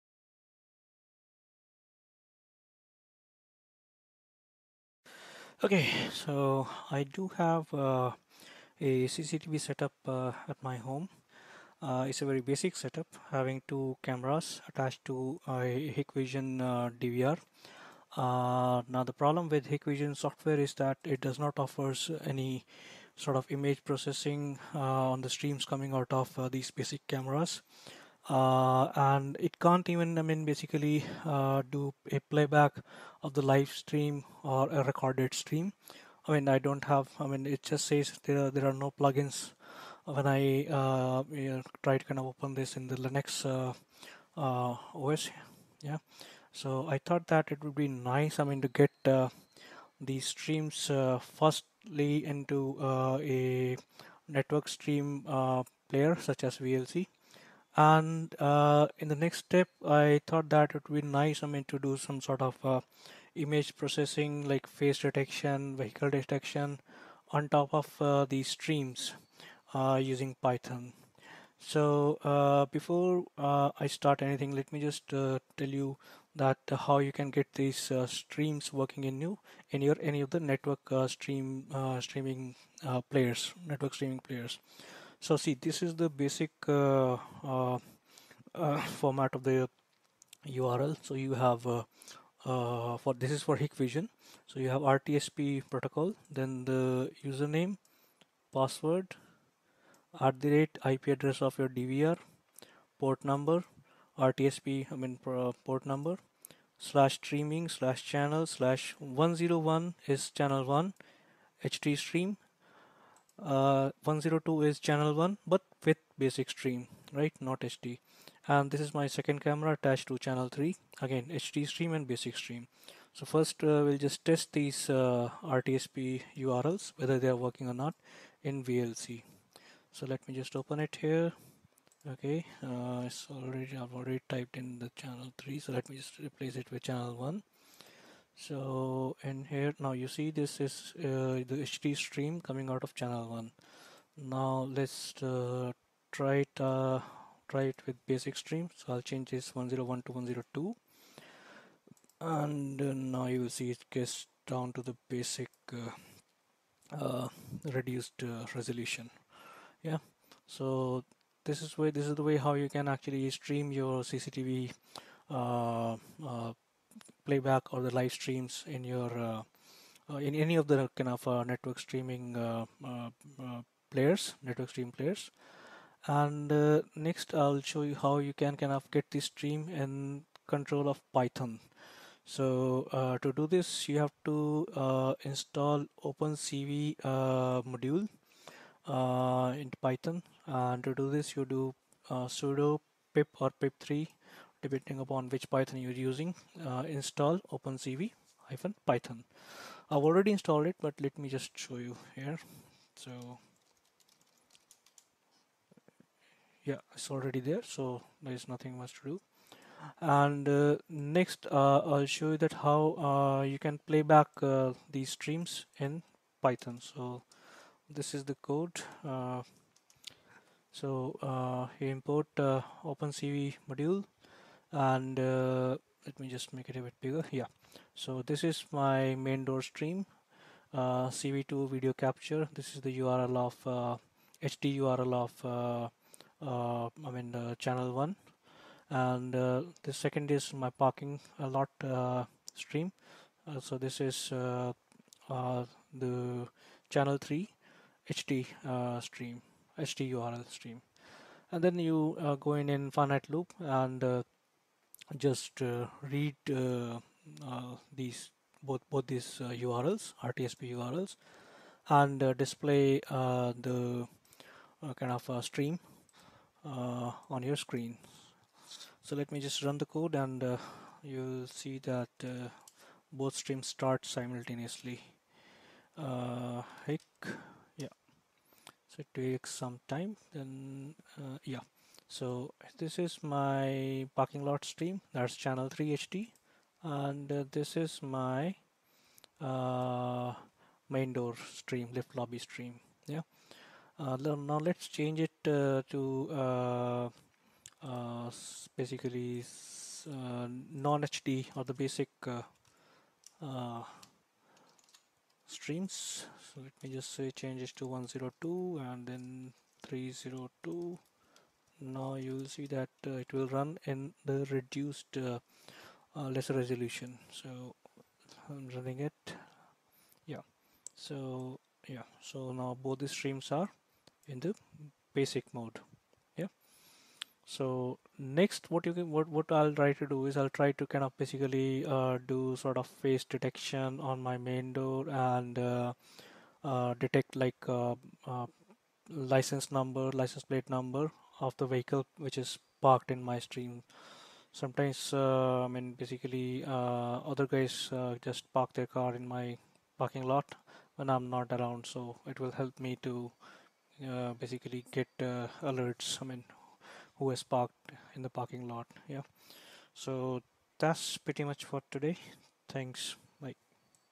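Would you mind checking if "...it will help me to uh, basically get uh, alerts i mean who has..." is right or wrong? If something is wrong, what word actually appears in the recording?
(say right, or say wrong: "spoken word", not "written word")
right.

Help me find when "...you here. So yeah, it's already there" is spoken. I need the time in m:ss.
3:21.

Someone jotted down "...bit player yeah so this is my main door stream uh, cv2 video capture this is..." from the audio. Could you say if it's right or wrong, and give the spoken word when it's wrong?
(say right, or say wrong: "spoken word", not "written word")
wrong: "bigger", not "player".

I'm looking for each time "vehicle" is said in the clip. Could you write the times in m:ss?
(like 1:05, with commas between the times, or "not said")
1:05, 5:41.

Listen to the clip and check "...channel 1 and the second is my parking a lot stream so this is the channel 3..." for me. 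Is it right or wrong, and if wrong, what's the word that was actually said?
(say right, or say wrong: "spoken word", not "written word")
right.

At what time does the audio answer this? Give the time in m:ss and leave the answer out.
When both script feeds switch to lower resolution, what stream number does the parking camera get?
5:09.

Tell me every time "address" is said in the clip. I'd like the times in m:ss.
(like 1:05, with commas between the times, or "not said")
1:41.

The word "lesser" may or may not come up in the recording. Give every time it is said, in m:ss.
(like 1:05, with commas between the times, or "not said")
5:16.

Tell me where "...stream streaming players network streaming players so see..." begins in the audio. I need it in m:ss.
1:21.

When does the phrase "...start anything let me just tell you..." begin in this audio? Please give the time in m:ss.
1:13.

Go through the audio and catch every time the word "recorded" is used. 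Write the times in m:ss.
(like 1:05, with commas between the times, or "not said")
0:34.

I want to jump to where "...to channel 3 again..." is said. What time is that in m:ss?
2:00.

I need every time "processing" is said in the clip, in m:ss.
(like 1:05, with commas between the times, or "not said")
0:23, 1:03.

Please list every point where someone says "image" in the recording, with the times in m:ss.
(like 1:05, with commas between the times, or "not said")
0:23, 1:03.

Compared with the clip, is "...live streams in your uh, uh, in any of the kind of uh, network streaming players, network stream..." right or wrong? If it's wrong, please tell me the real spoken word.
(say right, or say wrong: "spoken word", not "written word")
right.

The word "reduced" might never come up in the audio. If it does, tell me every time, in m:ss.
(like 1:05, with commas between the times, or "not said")
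2:37, 5:14.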